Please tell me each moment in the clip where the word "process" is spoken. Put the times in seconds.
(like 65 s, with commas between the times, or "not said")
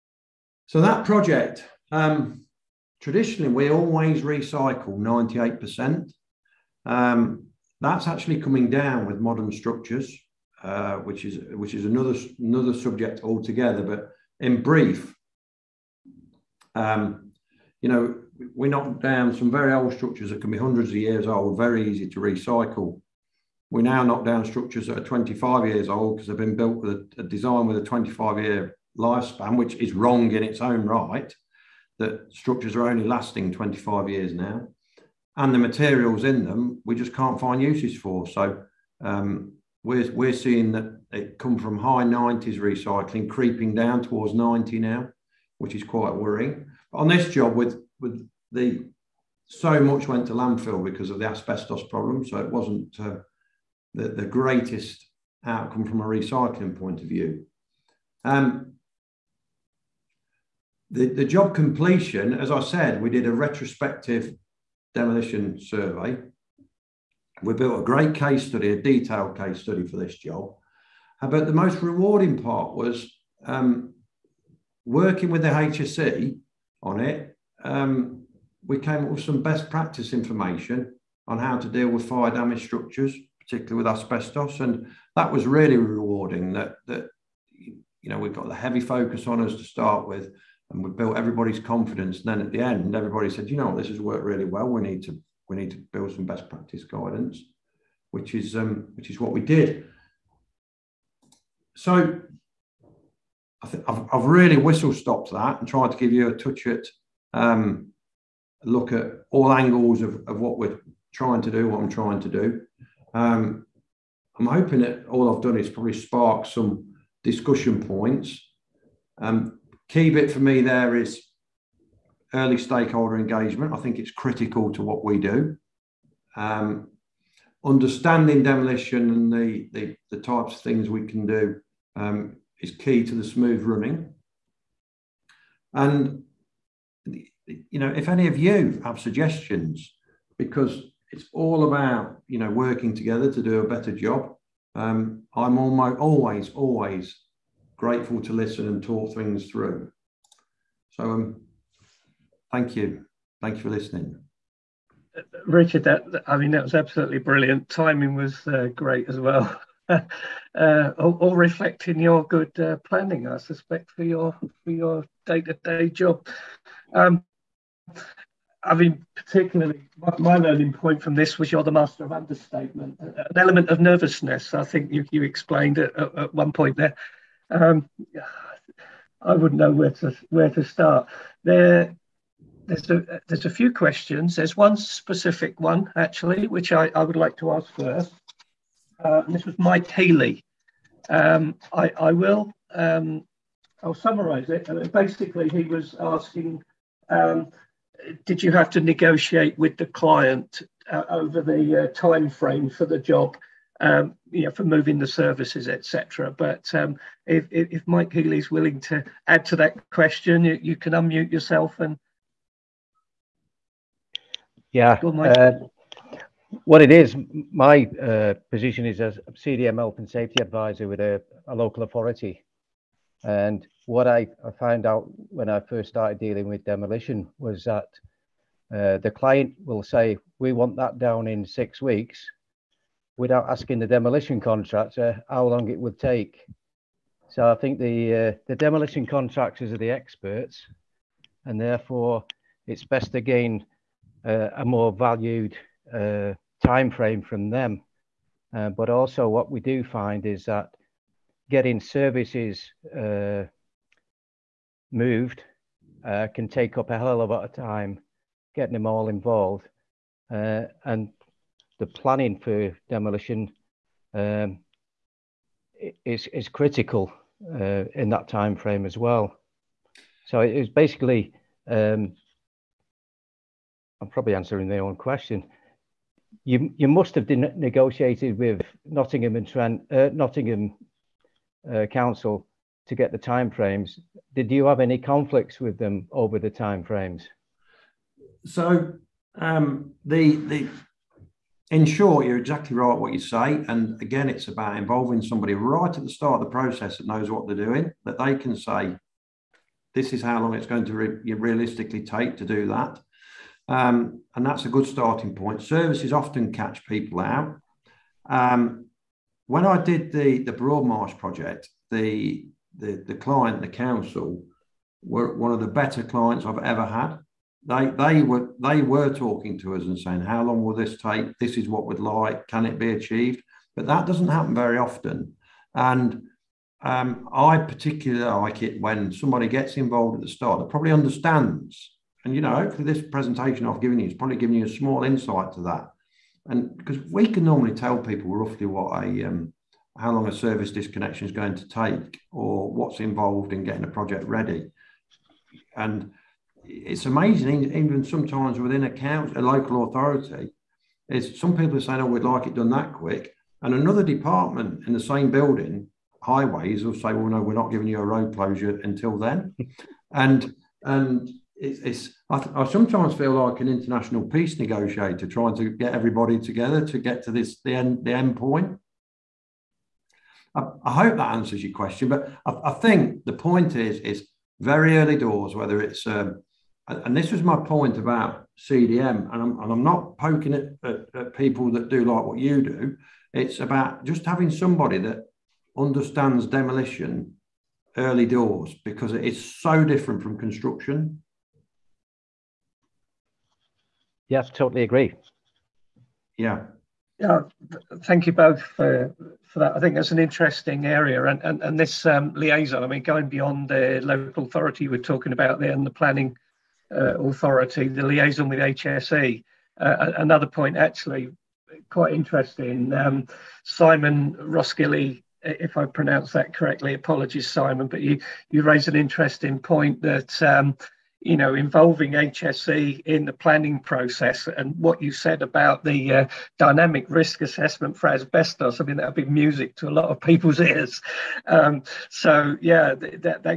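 296 s, 423 s.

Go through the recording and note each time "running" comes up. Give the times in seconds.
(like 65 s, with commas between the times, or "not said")
133 s.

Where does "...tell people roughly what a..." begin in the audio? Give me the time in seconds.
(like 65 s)
337 s.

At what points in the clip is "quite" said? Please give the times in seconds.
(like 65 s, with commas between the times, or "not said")
45 s, 411 s.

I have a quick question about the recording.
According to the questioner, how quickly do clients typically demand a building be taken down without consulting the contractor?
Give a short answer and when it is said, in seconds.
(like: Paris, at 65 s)
Six weeks, at 231 s.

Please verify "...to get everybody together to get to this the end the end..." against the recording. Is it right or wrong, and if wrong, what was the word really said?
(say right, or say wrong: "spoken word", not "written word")
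right.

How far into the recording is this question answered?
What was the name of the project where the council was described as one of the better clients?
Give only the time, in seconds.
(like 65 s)
310 s.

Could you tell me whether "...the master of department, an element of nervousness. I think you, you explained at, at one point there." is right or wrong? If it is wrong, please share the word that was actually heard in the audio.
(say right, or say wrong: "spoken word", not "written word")
wrong: "understatement", not "department".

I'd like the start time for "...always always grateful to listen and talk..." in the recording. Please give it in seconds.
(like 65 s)
145 s.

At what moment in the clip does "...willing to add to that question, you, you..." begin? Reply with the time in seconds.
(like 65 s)
208 s.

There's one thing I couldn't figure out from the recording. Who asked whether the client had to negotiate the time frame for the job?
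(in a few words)
Mike Healy.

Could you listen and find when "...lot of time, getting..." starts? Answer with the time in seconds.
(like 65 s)
257 s.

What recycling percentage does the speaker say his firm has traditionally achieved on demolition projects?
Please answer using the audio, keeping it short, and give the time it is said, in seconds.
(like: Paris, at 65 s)
98%, at 4 s.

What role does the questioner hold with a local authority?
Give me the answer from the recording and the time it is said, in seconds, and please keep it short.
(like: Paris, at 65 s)
CDM Health and Safety Advisor, at 219 s.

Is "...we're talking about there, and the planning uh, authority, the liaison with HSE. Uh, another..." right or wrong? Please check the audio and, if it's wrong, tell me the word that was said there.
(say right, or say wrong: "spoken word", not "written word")
right.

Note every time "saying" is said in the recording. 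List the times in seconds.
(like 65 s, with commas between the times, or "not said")
319 s, 351 s.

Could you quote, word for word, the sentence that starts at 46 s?
But on this job with with the so much went to landfill because of the asbestos problem.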